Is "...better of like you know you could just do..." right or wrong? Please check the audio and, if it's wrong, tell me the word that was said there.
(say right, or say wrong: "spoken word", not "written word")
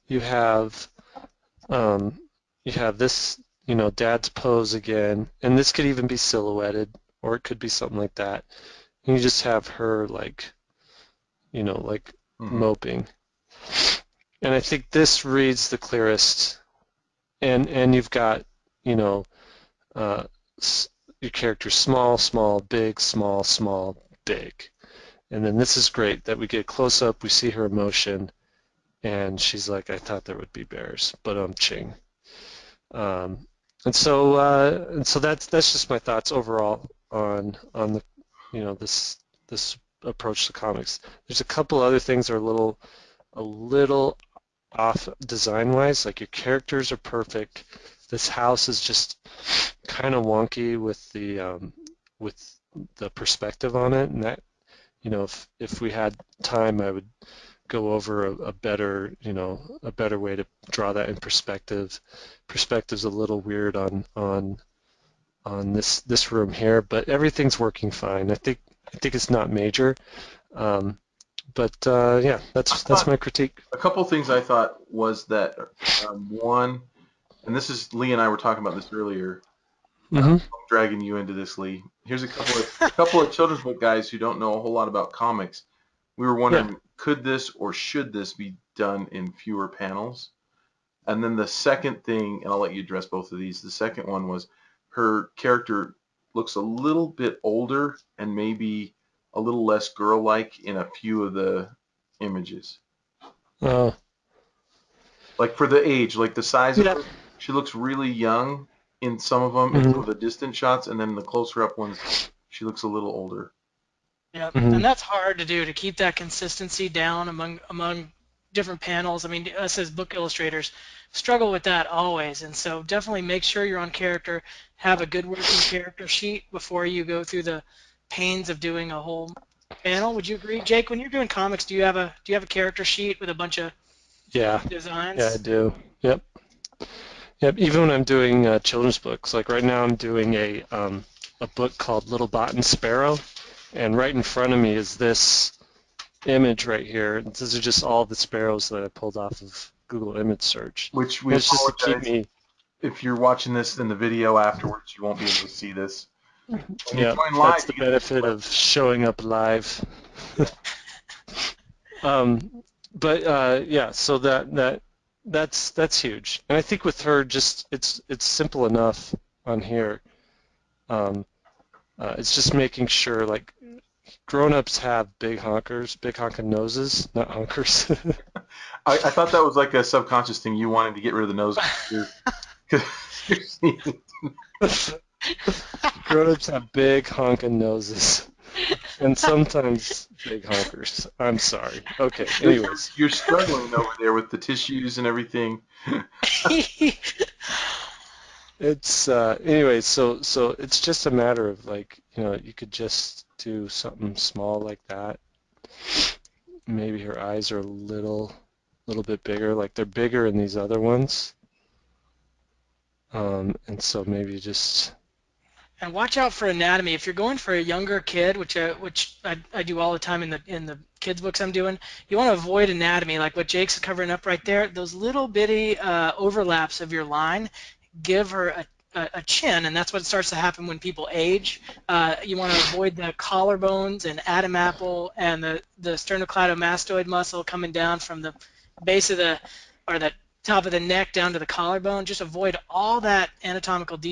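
wrong: "matter", not "better".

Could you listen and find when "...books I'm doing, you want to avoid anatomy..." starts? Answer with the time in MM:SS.
03:41.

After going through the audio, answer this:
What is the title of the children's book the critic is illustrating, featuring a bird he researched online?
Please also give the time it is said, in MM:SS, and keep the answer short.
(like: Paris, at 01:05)
Little Bot and Sparrow, at 02:22.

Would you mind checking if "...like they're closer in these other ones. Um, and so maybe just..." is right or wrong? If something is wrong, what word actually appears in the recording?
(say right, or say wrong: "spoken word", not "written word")
wrong: "bigger", not "closer".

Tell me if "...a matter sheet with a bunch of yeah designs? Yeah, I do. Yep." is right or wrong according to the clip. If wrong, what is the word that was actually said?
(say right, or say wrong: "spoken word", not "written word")
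wrong: "character", not "matter".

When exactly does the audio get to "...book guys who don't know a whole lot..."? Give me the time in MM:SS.
01:23.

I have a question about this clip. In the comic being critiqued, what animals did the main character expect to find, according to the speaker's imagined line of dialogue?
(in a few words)
bears.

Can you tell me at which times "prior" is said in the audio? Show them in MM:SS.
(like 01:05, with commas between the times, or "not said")
not said.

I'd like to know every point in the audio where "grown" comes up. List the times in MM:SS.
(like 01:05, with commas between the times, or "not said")
02:54, 03:06.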